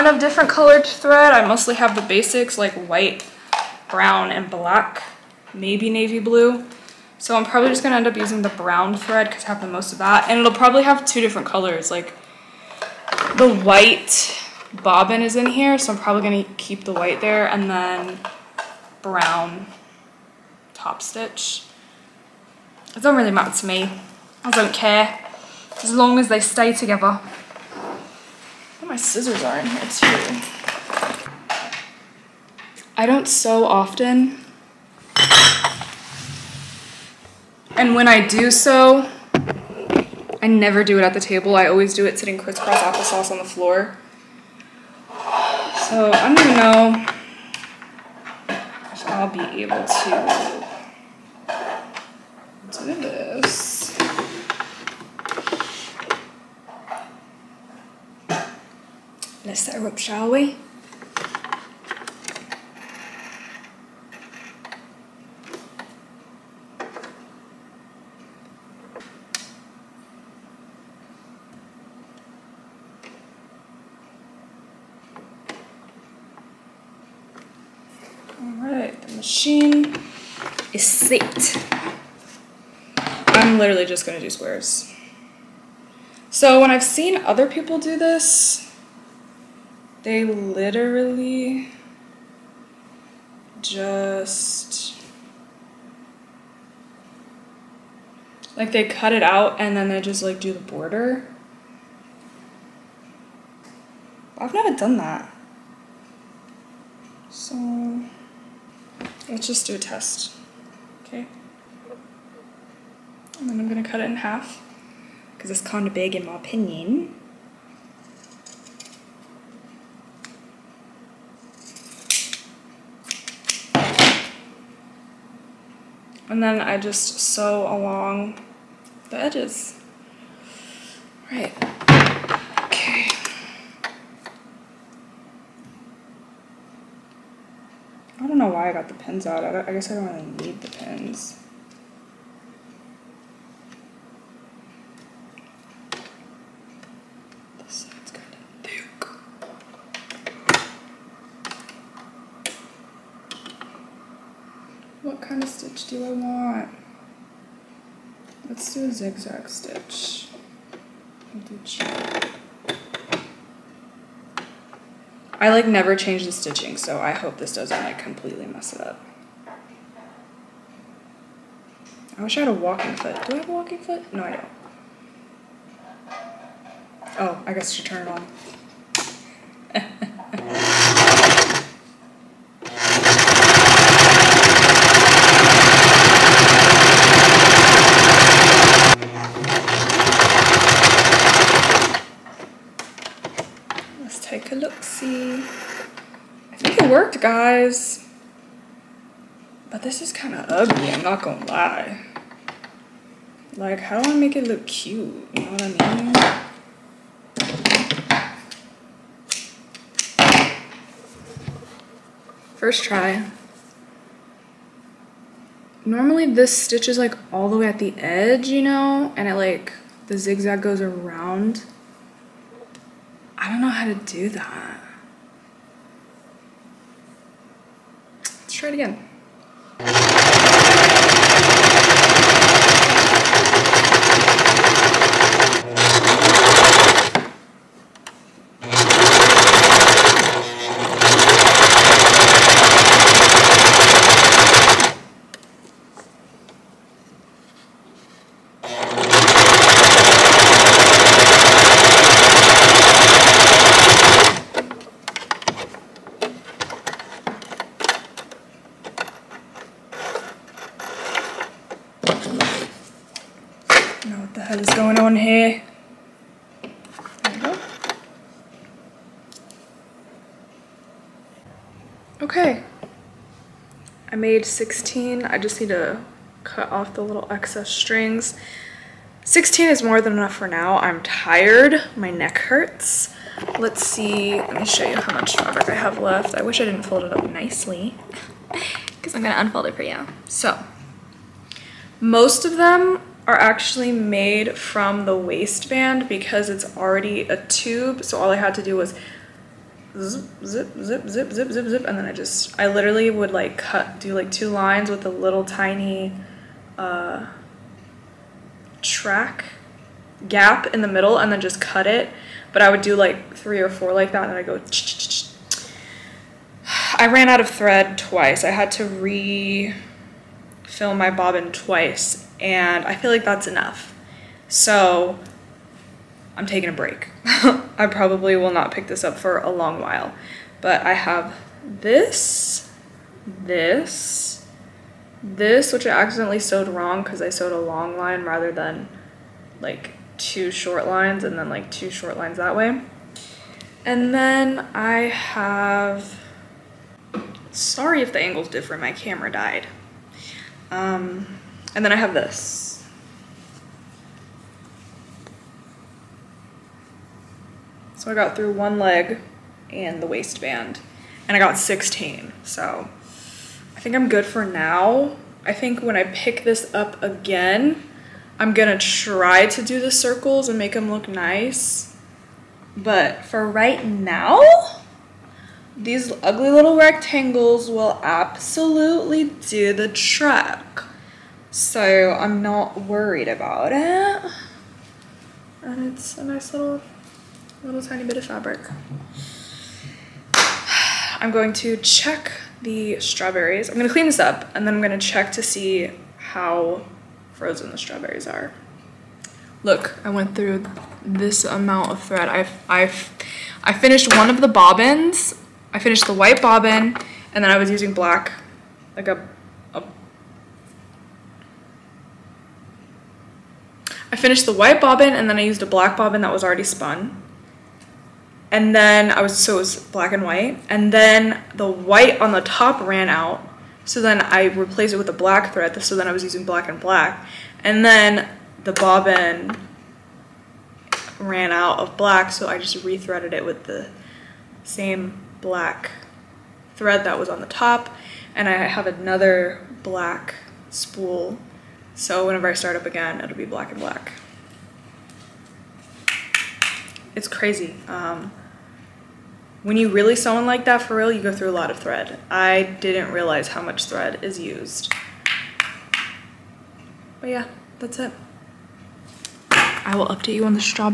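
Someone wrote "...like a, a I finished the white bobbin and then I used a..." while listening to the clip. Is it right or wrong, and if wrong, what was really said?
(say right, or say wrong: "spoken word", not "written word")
right.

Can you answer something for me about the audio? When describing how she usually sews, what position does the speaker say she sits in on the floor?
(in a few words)
crisscross applesauce.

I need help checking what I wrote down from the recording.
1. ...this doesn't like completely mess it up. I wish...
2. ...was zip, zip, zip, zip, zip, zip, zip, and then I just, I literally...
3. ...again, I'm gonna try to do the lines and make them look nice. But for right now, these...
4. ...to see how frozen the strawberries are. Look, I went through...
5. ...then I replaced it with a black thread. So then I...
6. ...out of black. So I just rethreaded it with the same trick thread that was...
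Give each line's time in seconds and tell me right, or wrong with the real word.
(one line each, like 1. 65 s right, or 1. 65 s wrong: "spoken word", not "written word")
1. 167 s right
2. 298 s right
3. 367 s wrong: "circles", not "lines"
4. 395 s right
5. 424 s right
6. 431 s wrong: "black", not "trick".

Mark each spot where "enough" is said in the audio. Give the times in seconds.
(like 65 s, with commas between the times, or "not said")
280 s, 323 s.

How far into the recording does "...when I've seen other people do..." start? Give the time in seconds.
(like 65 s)
86 s.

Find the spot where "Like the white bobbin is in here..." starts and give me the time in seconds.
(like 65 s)
11 s.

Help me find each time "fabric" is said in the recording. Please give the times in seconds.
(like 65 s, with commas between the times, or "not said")
285 s, 388 s.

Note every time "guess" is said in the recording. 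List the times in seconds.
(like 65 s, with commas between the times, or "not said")
139 s, 177 s.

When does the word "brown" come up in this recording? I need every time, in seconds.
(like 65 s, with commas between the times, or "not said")
3 s, 8 s, 19 s.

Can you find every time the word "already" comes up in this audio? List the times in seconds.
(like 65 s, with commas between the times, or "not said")
296 s, 416 s.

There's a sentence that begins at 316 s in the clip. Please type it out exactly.
I ran out of thread twice.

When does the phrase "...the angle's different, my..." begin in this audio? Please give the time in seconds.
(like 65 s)
348 s.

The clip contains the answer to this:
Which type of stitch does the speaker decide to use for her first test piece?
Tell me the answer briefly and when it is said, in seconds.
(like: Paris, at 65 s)
zigzag stitch, at 158 s.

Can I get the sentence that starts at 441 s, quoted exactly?
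So whenever I start up again, it'll be black and black.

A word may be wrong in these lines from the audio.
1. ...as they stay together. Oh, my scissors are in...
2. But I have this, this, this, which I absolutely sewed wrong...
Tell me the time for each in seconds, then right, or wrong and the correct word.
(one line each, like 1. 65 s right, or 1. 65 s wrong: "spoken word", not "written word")
1. 26 s right
2. 330 s wrong: "accidentally", not "absolutely".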